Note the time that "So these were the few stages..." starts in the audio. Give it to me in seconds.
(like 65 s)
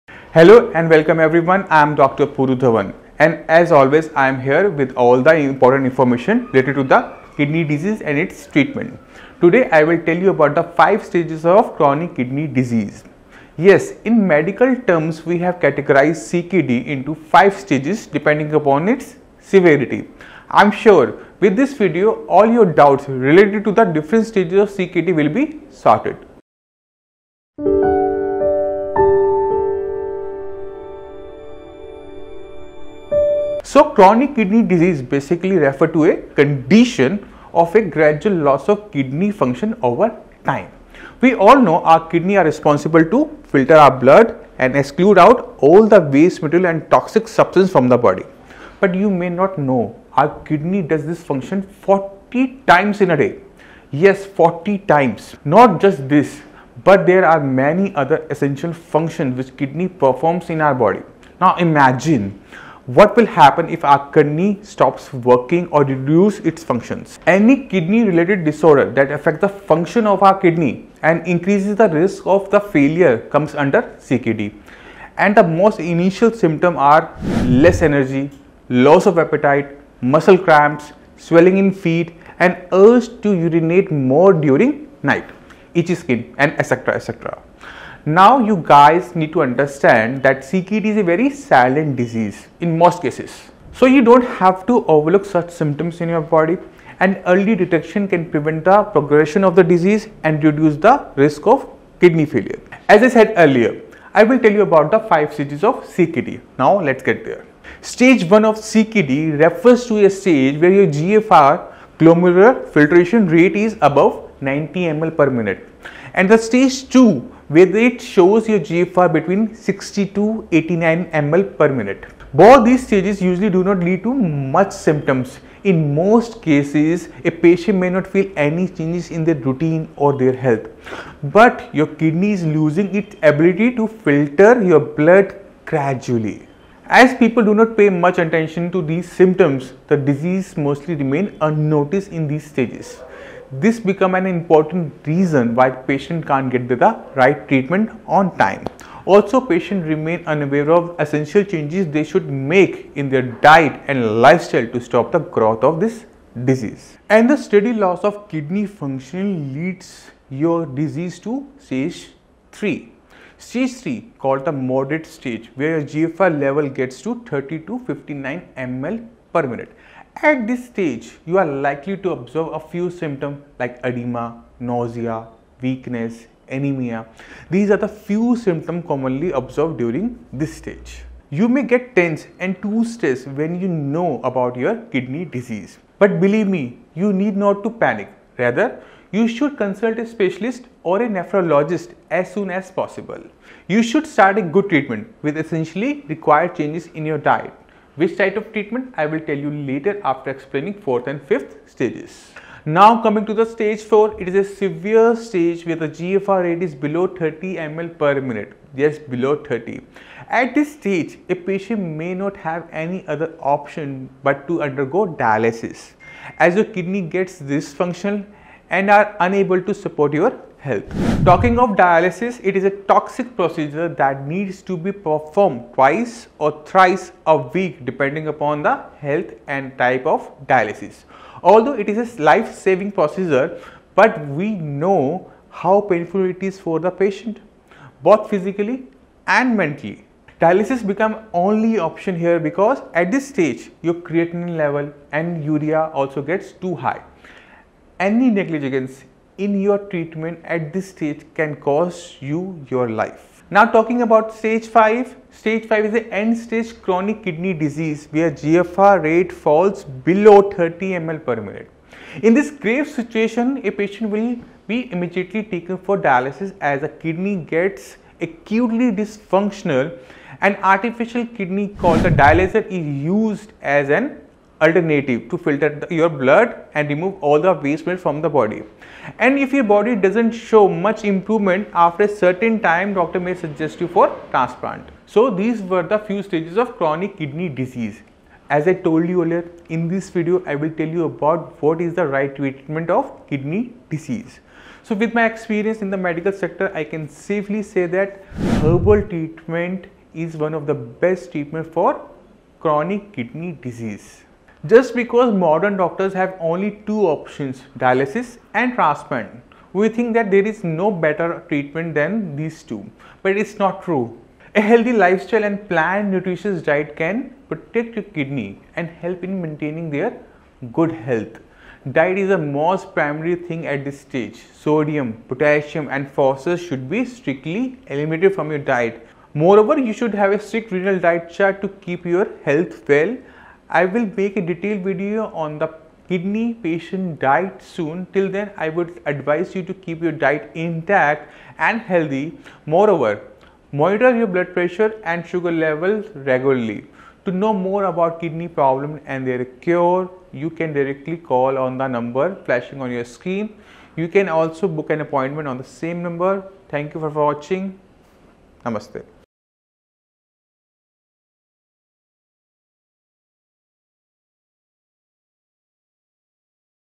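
285 s.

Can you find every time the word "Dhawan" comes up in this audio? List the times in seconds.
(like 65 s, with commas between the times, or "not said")
2 s.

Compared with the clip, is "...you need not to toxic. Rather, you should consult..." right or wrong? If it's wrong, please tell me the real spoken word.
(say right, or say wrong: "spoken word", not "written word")
wrong: "panic", not "toxic".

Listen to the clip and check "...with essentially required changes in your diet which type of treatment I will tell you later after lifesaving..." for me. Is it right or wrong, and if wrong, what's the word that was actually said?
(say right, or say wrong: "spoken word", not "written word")
wrong: "explaining", not "lifesaving".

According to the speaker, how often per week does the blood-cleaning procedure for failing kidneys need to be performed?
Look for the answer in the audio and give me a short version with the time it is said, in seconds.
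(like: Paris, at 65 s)
twice or thrice, at 225 s.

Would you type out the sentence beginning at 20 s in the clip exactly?
I am sure with this video all your doubts related to the different stages of CKD will be sorted.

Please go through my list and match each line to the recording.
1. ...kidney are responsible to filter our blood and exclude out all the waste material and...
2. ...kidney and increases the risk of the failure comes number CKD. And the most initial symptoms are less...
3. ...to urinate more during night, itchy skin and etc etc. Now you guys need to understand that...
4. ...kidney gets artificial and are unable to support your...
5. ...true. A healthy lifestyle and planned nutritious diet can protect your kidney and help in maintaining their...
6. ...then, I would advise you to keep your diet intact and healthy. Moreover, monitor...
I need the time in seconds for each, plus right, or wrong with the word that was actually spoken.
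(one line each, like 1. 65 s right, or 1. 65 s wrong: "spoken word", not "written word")
1. 42 s right
2. 70 s wrong: "under", not "number"
3. 83 s right
4. 216 s wrong: "dysfunctional", not "artificial"
5. 313 s right
6. 338 s right.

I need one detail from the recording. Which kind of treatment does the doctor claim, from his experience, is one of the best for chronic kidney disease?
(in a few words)
Herbal treatment.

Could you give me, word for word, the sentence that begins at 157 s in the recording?
And the steady loss of kidney function leads your disease to stage 3.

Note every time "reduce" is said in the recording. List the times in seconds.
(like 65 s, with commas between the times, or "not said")
65 s, 100 s.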